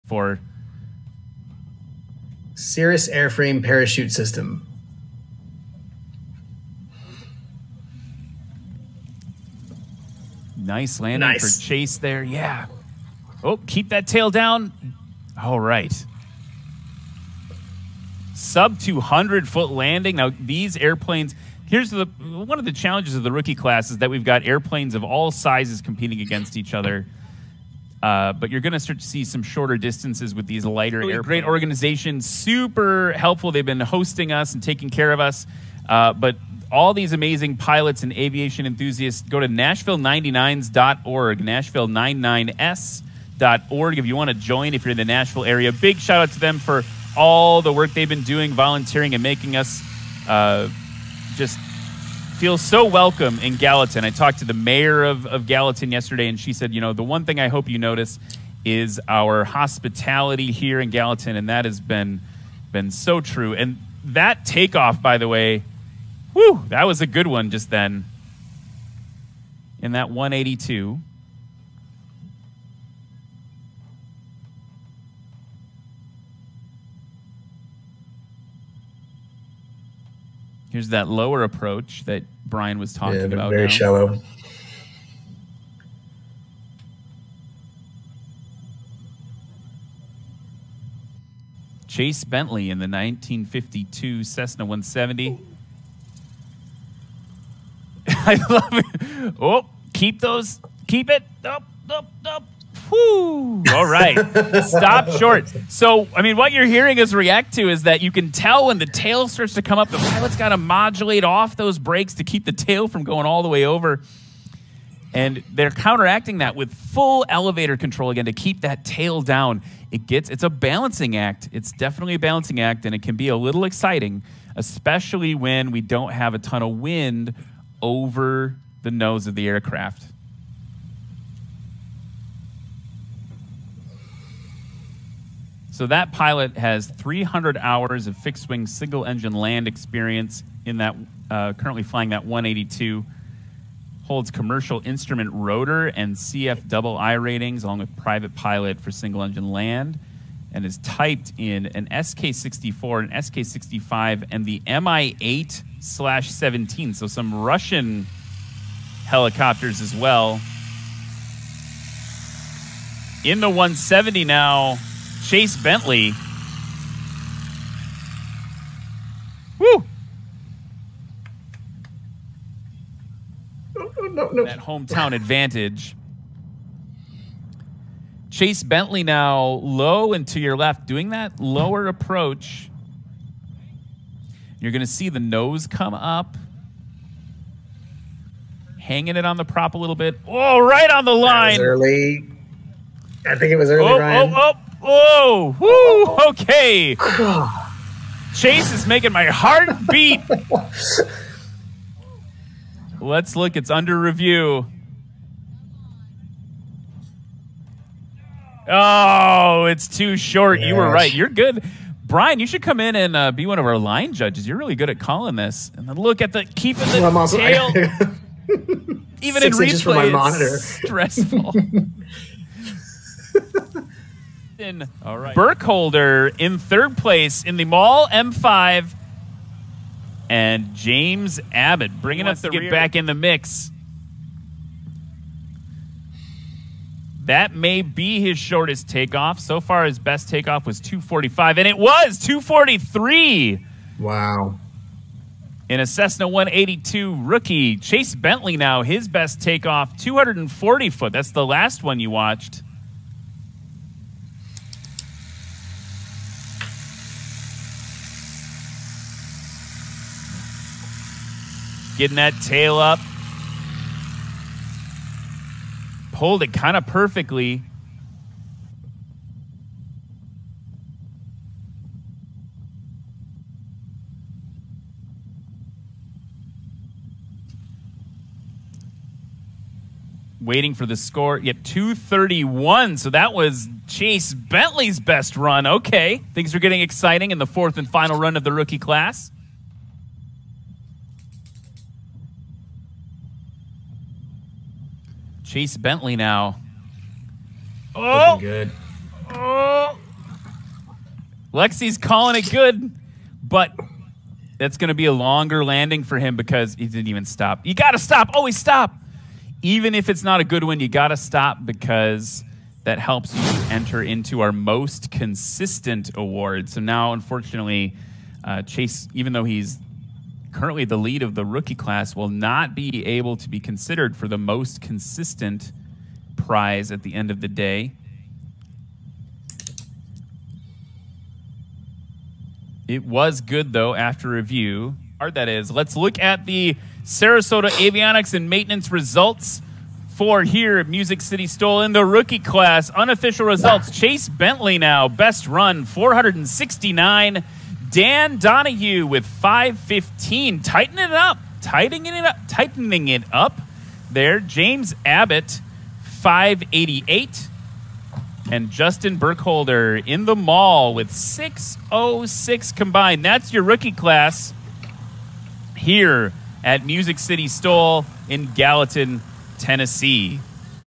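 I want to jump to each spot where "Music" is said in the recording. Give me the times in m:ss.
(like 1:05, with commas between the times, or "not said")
5:40, 6:06.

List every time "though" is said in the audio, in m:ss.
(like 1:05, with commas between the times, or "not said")
5:19, 5:33.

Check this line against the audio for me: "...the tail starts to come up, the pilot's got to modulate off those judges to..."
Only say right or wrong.
wrong.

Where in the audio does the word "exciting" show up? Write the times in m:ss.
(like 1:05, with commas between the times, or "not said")
2:03, 4:46.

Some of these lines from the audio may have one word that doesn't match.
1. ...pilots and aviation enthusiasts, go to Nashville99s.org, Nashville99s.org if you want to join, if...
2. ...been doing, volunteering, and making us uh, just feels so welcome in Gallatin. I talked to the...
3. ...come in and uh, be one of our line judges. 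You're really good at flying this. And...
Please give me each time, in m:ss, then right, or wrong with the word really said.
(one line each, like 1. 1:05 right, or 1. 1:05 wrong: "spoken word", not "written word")
1. 0:37 right
2. 0:48 right
3. 3:32 wrong: "calling", not "flying".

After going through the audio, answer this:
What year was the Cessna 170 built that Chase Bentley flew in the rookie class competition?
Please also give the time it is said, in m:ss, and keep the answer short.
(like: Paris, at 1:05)
1952, at 1:32.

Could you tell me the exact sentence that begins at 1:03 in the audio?
And that takeoff, by the way, whew, that was a good one just then.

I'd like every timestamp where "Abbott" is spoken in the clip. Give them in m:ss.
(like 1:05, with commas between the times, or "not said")
3:51, 5:55.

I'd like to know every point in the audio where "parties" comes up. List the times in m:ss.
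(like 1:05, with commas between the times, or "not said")
not said.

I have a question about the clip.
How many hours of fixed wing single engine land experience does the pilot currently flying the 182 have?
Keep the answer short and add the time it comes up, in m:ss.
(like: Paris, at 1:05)
300, at 2:16.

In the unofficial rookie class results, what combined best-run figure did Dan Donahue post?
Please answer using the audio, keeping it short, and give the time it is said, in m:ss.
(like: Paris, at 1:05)
515, at 5:49.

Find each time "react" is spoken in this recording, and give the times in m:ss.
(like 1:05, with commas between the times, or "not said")
1:47.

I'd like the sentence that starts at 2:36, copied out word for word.
So some Russian helicopters as well.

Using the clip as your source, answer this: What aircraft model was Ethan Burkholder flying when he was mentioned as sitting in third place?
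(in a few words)
Maule M5.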